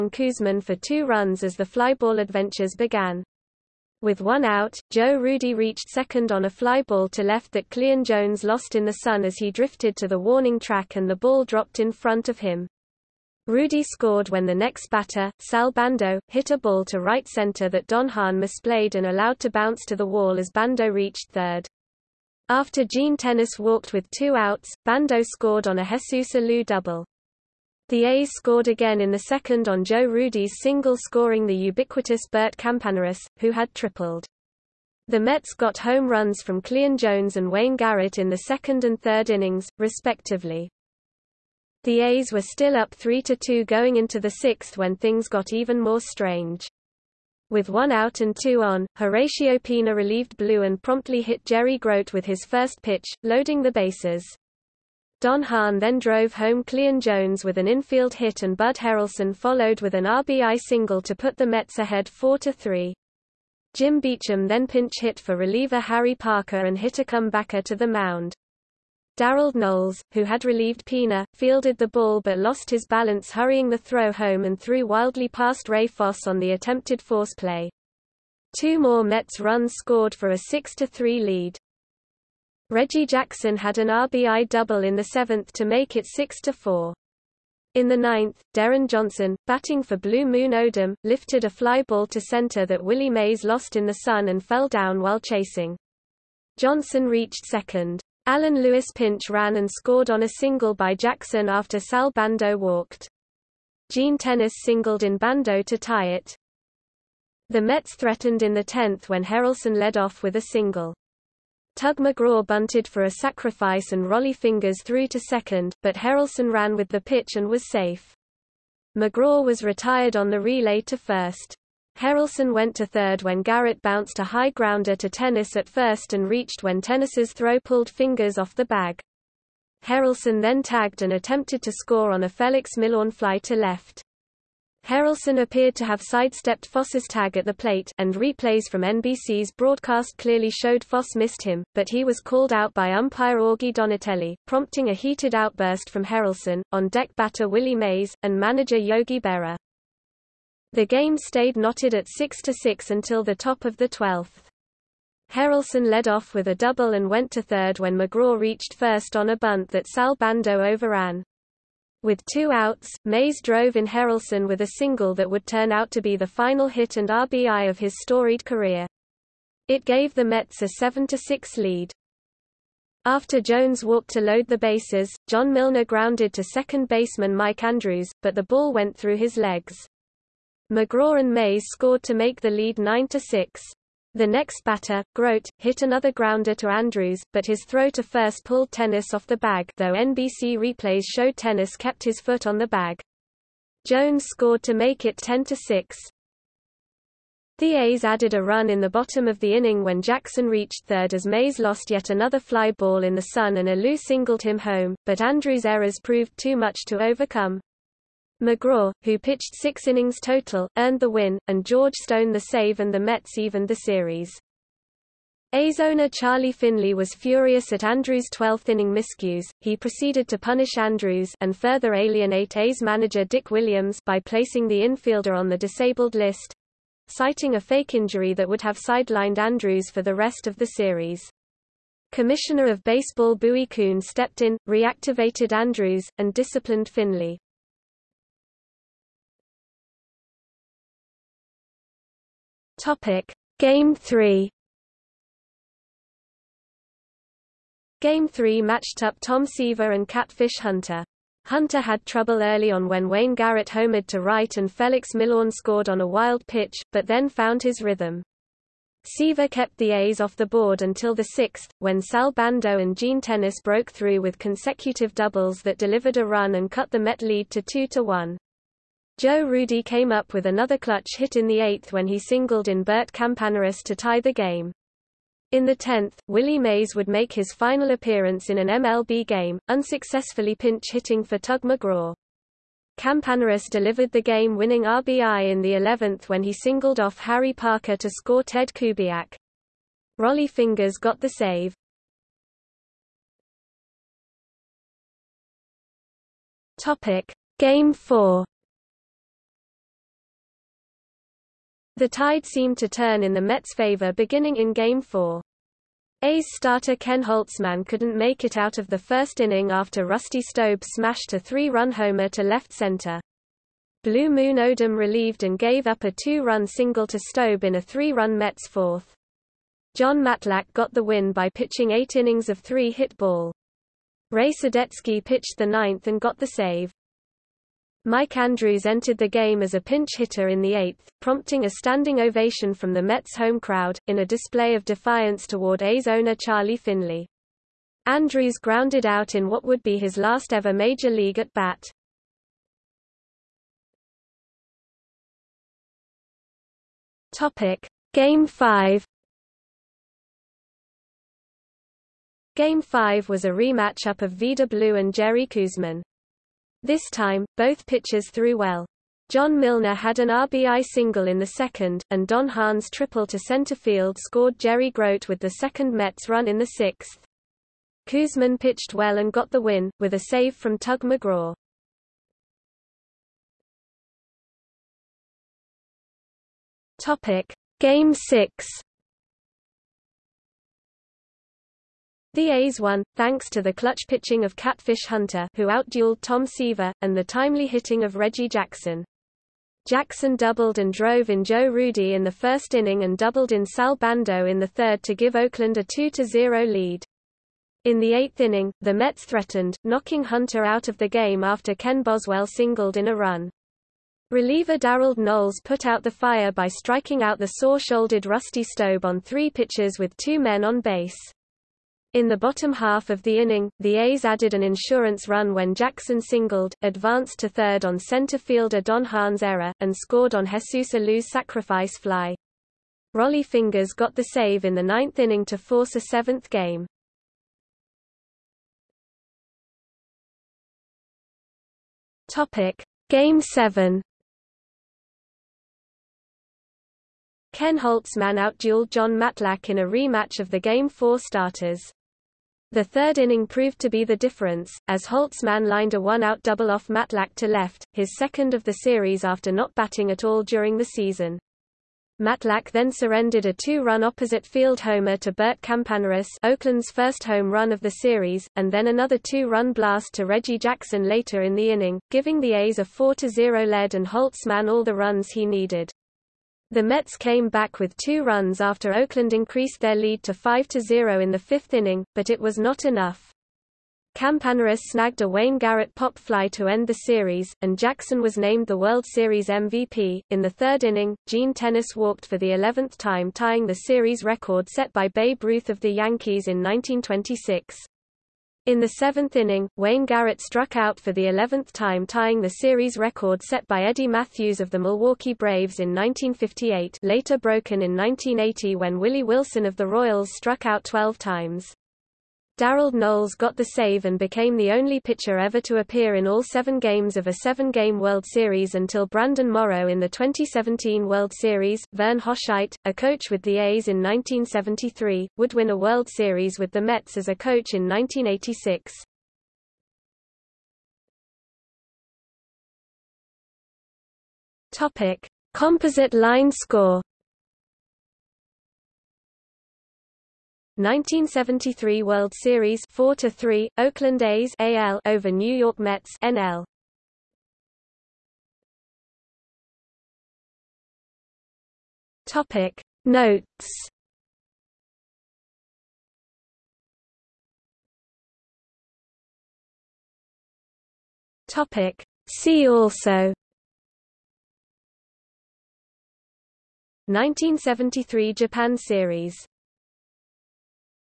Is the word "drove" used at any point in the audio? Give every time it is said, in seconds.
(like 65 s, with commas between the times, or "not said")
55 s, 163 s, 390 s.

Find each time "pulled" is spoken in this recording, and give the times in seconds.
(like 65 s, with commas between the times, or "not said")
127 s, 188 s.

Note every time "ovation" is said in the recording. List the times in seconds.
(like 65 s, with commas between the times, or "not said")
332 s.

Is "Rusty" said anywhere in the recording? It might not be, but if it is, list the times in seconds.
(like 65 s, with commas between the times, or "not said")
310 s, 408 s.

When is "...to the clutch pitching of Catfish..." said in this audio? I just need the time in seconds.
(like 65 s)
383 s.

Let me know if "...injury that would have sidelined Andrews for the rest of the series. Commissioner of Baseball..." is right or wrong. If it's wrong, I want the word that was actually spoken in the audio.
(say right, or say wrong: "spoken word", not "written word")
right.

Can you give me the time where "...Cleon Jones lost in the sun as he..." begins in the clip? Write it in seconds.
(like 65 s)
7 s.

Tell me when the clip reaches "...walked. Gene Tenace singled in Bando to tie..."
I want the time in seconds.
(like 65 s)
102 s.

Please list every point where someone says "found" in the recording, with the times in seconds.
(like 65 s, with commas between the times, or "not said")
257 s.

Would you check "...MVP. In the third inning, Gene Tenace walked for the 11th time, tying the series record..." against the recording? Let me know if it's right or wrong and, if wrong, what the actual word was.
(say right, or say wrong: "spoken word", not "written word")
right.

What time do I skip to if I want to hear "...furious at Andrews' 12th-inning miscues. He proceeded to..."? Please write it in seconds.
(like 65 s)
217 s.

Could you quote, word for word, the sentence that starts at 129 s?
Harrelson then tagged and attempted to score on a Felix Millan fly to left.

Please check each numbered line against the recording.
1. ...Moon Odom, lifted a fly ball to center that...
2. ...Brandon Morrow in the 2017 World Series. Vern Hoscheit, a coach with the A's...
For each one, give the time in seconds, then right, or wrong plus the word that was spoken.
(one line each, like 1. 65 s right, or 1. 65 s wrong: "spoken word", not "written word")
1. 90 s right
2. 509 s right.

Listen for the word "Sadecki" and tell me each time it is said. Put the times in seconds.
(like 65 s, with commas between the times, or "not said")
324 s.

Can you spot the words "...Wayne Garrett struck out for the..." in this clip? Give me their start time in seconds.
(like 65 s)
489 s.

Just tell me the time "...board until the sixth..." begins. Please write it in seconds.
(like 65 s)
260 s.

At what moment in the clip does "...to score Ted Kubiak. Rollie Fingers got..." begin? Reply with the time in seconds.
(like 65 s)
287 s.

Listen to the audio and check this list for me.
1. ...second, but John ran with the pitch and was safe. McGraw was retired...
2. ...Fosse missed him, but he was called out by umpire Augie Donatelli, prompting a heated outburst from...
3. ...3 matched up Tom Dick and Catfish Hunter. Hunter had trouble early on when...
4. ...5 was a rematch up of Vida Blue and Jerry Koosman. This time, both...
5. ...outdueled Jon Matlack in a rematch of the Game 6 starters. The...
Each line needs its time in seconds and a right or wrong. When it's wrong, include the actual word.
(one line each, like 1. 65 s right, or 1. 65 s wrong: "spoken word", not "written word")
1. 115 s wrong: "Harrelson", not "John"
2. 140 s right
3. 248 s wrong: "Seaver", not "Dick"
4. 352 s right
5. 438 s wrong: "4", not "6".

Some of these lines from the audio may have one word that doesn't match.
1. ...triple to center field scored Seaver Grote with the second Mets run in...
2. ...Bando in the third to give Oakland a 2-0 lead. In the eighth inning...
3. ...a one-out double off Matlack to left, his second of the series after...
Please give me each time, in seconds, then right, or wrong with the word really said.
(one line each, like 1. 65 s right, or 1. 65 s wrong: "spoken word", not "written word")
1. 362 s wrong: "Jerry", not "Seaver"
2. 393 s right
3. 445 s right.